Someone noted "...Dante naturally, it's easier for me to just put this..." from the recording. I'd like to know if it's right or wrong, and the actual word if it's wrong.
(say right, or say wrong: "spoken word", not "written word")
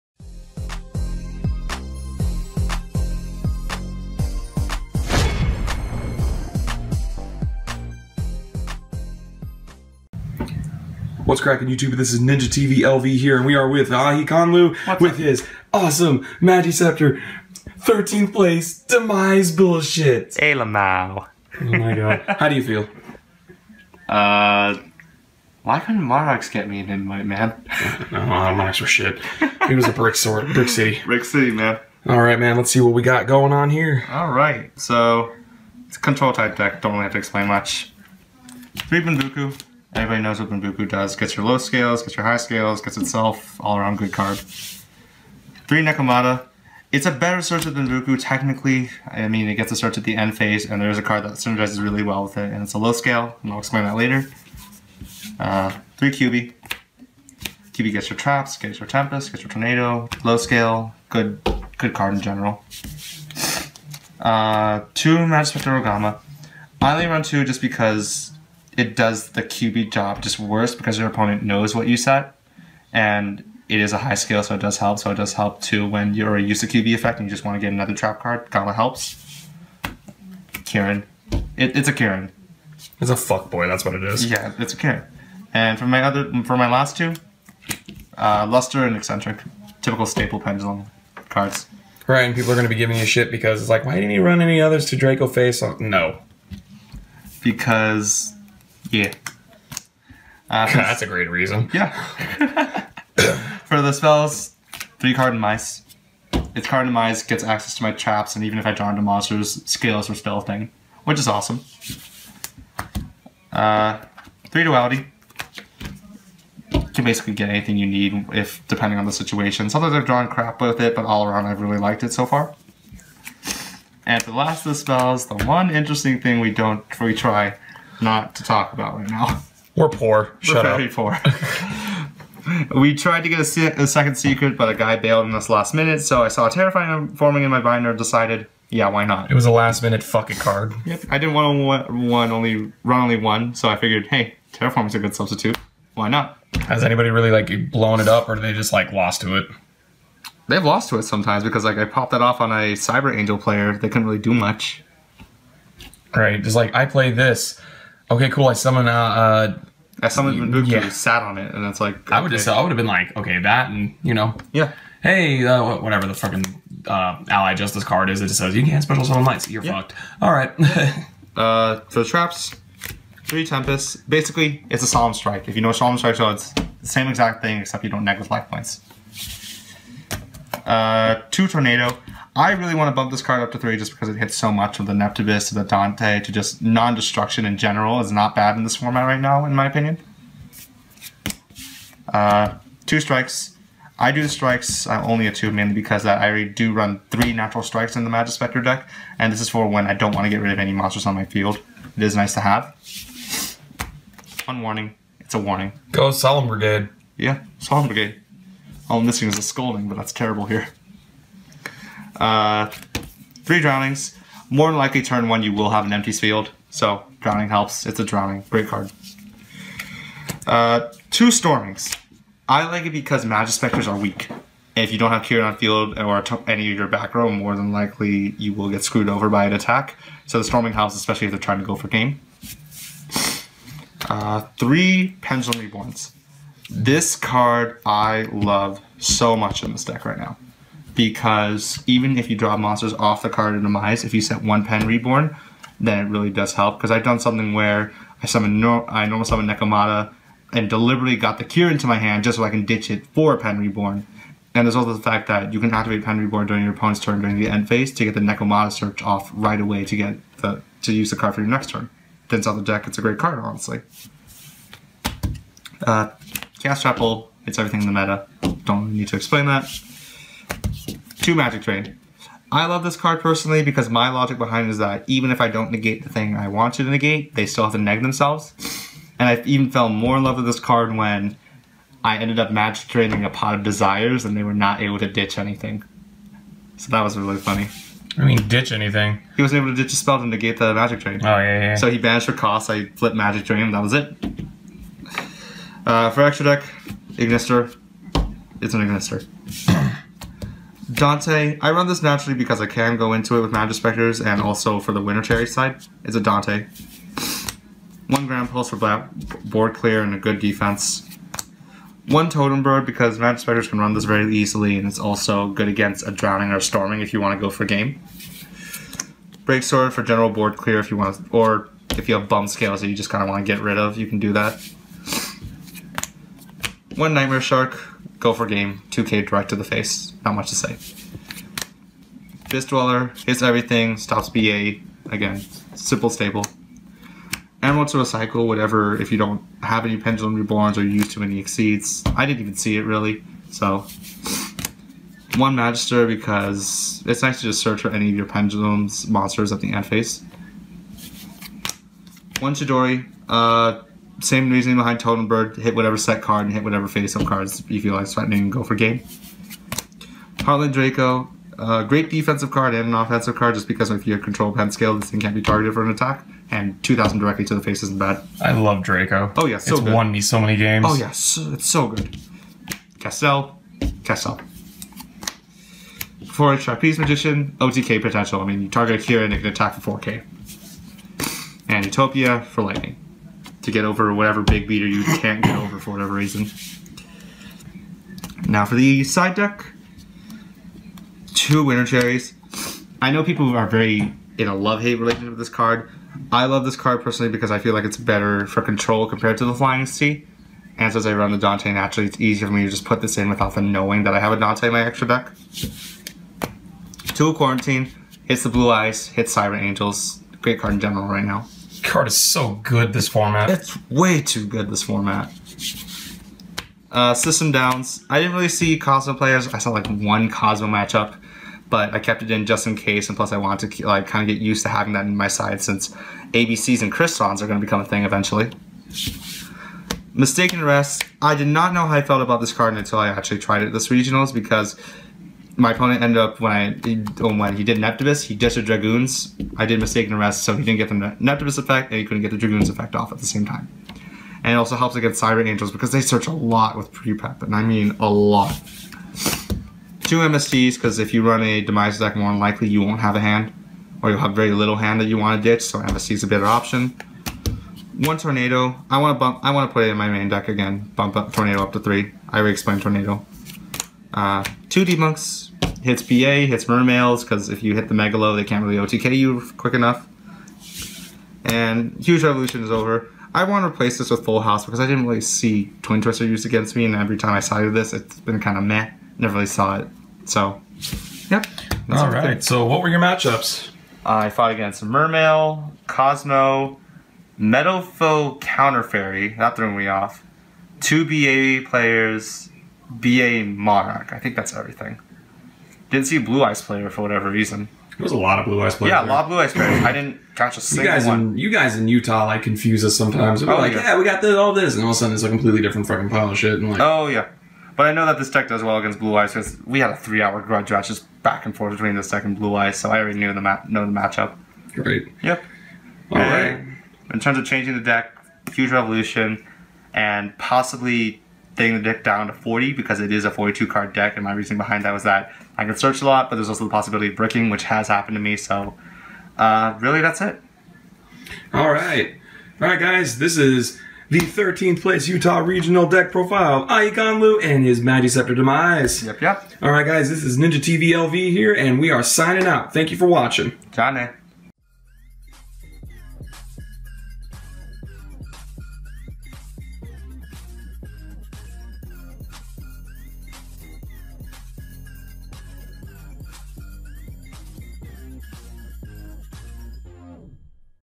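right.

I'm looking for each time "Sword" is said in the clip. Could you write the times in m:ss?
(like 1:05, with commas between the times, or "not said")
5:19.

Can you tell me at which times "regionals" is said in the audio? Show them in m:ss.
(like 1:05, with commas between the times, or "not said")
7:13, 8:55.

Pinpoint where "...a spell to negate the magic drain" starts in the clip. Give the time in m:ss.
4:49.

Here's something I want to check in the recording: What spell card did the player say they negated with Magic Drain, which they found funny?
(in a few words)
Pot of Desires.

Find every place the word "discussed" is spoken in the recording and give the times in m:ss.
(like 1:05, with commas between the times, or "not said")
not said.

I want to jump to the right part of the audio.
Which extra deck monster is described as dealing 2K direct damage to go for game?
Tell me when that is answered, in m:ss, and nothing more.
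5:27.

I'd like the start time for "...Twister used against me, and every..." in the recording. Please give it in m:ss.
7:56.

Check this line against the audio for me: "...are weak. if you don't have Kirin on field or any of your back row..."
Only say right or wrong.
right.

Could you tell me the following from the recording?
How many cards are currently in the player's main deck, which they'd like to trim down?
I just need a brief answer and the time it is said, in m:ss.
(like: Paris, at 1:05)
42, at 8:43.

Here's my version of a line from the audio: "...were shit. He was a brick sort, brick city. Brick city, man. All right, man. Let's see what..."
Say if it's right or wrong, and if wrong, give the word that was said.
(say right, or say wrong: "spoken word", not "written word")
right.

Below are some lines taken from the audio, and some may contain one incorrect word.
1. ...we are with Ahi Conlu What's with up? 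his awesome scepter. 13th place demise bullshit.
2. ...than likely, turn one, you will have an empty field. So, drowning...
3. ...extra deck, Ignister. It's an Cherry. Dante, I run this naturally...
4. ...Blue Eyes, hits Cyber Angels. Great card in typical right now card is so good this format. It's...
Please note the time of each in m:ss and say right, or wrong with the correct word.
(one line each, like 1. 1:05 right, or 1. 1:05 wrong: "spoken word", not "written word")
1. 0:13 right
2. 3:34 right
3. 4:56 wrong: "Ignister", not "Cherry"
4. 6:48 wrong: "general", not "typical".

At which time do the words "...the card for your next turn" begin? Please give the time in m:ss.
4:21.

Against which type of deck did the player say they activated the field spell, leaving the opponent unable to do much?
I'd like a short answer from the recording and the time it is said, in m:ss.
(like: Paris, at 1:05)
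Cyber Angel, at 2:32.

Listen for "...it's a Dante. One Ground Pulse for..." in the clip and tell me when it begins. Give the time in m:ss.
5:06.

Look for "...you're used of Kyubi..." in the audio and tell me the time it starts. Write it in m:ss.
1:16.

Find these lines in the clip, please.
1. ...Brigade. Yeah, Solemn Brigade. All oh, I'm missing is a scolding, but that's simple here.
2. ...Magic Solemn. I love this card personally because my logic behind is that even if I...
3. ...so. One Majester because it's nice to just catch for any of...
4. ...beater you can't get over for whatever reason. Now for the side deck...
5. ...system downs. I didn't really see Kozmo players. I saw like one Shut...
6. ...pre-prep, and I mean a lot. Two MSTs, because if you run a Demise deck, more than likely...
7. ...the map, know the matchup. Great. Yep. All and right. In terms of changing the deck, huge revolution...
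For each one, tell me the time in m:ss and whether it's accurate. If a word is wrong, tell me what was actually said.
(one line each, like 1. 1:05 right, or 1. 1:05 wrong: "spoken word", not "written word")
1. 3:26 wrong: "terrible", not "simple"
2. 4:31 wrong: "Drain", not "Solemn"
3. 5:43 wrong: "search", not "catch"
4. 6:24 right
5. 6:57 wrong: "Kozmo", not "Shut"
6. 7:26 right
7. 8:33 right.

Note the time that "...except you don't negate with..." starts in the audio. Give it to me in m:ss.
2:57.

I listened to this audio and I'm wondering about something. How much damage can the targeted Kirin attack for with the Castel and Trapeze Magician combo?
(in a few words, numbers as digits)
4K.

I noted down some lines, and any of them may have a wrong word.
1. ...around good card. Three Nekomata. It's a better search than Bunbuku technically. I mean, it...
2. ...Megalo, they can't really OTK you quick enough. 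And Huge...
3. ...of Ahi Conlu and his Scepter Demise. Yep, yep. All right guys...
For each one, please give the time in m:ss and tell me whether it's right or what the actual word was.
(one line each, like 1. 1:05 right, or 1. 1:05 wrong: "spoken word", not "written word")
1. 0:43 right
2. 7:47 right
3. 8:56 right.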